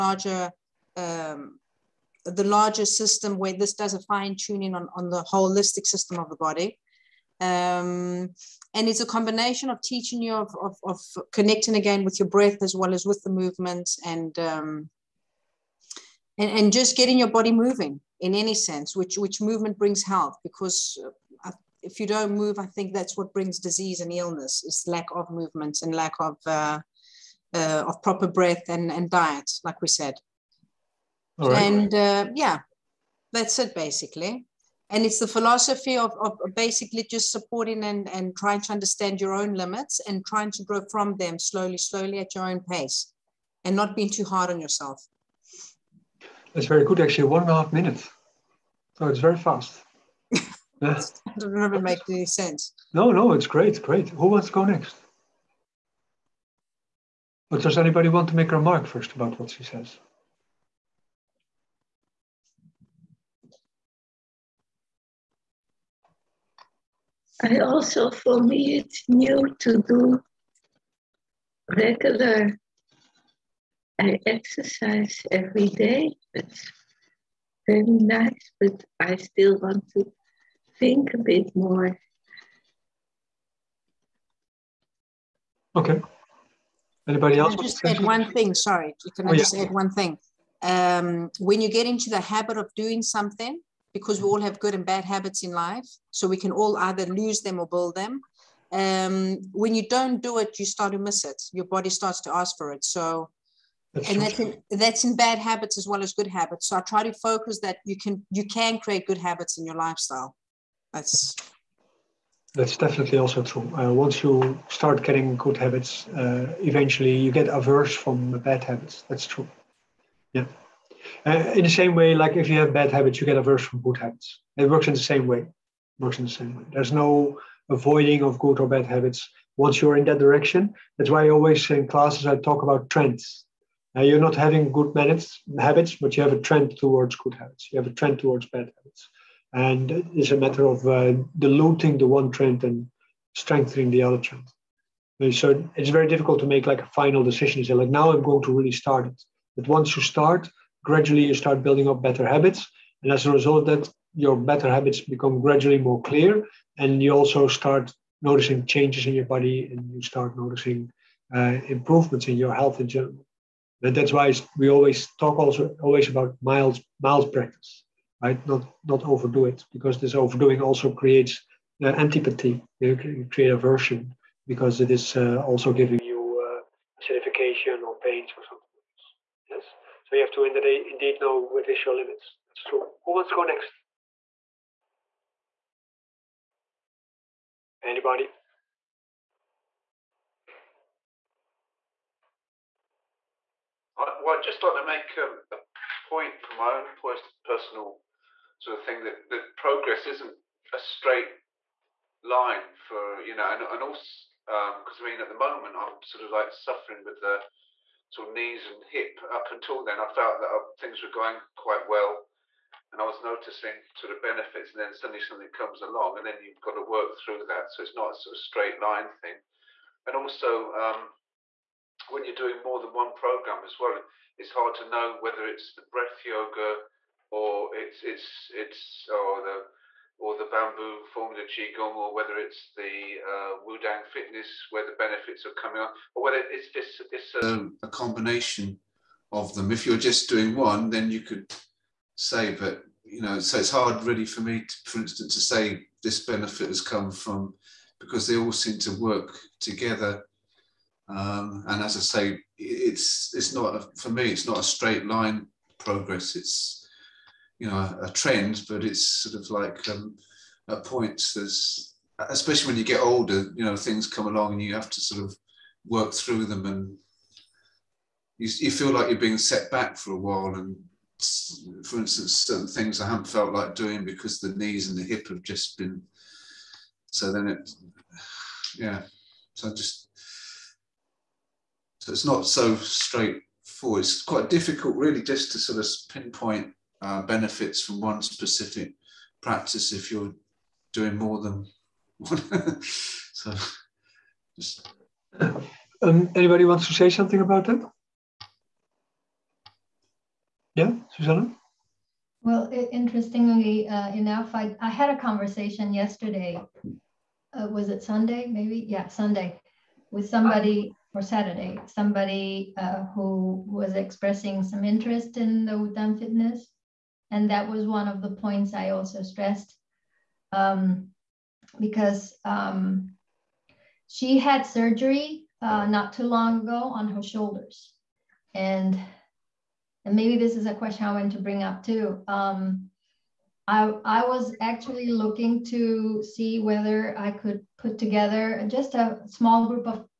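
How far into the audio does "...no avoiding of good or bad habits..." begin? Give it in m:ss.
2:06.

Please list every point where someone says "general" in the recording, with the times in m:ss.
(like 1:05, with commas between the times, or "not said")
2:42.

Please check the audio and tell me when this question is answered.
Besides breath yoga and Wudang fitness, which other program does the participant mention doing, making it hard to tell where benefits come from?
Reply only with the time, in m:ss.
3:50.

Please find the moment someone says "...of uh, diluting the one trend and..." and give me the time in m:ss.
2:20.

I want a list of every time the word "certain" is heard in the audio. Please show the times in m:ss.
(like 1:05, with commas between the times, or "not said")
4:32.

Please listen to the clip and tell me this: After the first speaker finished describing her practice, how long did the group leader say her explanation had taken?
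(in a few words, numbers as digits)
1.5 minutes.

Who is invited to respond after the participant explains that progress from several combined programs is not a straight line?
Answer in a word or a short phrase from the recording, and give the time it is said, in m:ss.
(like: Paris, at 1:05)
Susanna, at 5:01.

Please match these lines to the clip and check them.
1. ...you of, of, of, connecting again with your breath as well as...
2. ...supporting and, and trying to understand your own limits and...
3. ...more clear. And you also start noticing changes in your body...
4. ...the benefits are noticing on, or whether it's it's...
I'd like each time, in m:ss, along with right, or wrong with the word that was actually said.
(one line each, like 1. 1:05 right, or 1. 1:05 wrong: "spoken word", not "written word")
1. 0:10 right
2. 0:37 right
3. 2:35 right
4. 3:54 wrong: "coming", not "noticing".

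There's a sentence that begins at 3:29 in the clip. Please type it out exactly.
Up until then, I felt that uh, things were going quite well and I was noticing sort of benefits.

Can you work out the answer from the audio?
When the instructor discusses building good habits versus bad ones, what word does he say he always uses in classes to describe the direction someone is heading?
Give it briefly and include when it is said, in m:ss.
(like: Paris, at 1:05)
trends, at 2:12.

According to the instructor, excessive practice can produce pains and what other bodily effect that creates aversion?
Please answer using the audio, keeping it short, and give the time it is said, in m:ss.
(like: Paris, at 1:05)
acidification, at 2:57.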